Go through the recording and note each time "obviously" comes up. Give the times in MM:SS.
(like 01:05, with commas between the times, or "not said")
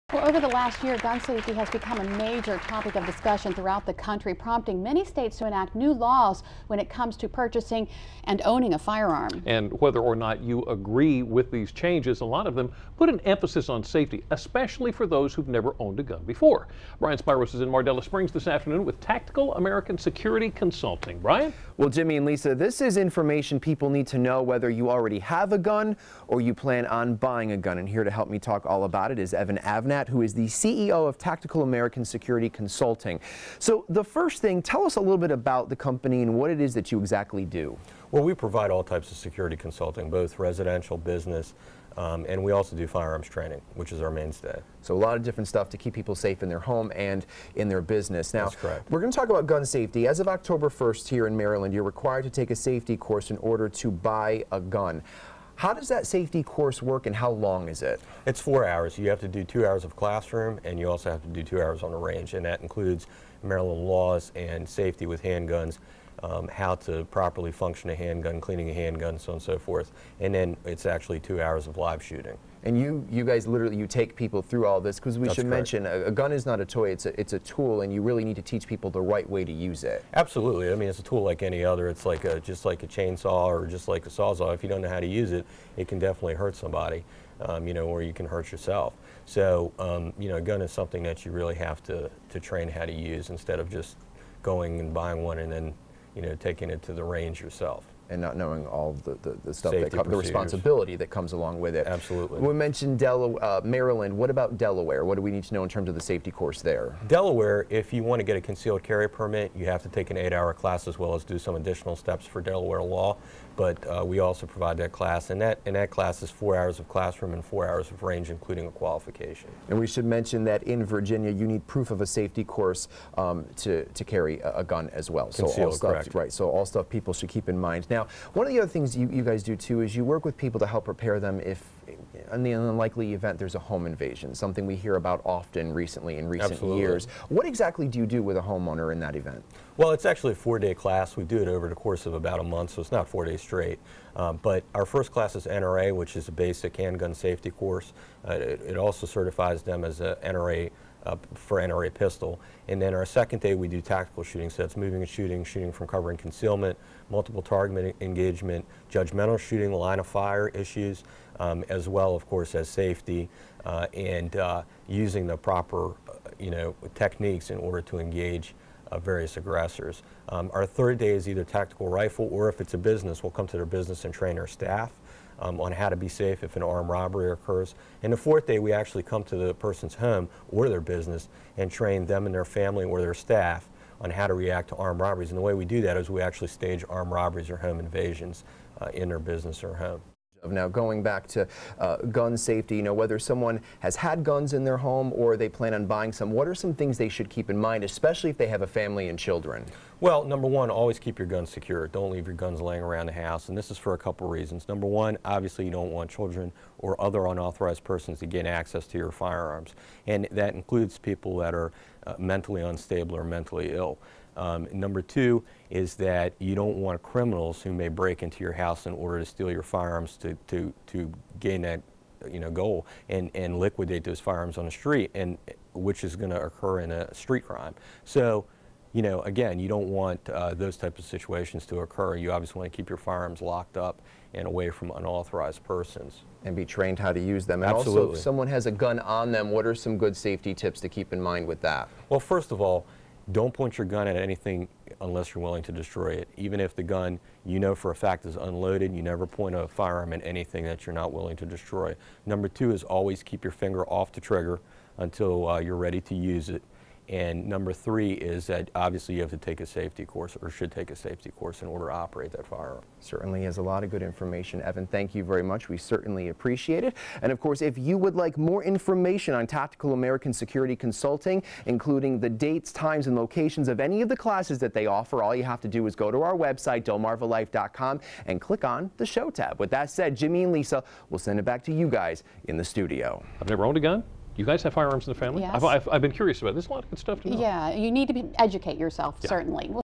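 03:25, 03:52, 04:18.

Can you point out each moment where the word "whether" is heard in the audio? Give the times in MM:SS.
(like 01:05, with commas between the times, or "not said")
00:09, 00:24, 03:12.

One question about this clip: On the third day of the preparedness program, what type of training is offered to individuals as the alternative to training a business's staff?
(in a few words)
Tactical rifle.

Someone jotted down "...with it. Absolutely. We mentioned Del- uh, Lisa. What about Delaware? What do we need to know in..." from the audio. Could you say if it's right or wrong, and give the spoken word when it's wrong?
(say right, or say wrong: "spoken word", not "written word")
wrong: "Maryland", not "Lisa".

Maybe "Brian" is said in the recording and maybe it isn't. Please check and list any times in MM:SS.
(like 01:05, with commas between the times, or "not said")
00:16, 00:21.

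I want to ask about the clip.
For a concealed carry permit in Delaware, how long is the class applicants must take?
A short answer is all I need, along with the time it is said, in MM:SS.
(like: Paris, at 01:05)
8 hours, at 01:50.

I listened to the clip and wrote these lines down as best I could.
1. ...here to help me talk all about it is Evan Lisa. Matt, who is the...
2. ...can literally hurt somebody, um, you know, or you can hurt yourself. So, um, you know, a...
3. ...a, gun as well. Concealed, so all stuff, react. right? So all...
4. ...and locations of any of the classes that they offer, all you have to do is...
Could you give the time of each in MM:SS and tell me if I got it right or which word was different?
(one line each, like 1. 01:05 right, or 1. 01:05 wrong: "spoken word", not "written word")
1. 00:27 wrong: "Avnet", not "Lisa"
2. 01:25 wrong: "definitely", not "literally"
3. 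02:04 wrong: "correct", not "react"
4. 04:33 right.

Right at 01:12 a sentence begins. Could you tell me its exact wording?
And you, you guys literally, you take people through all this because we That's should correct.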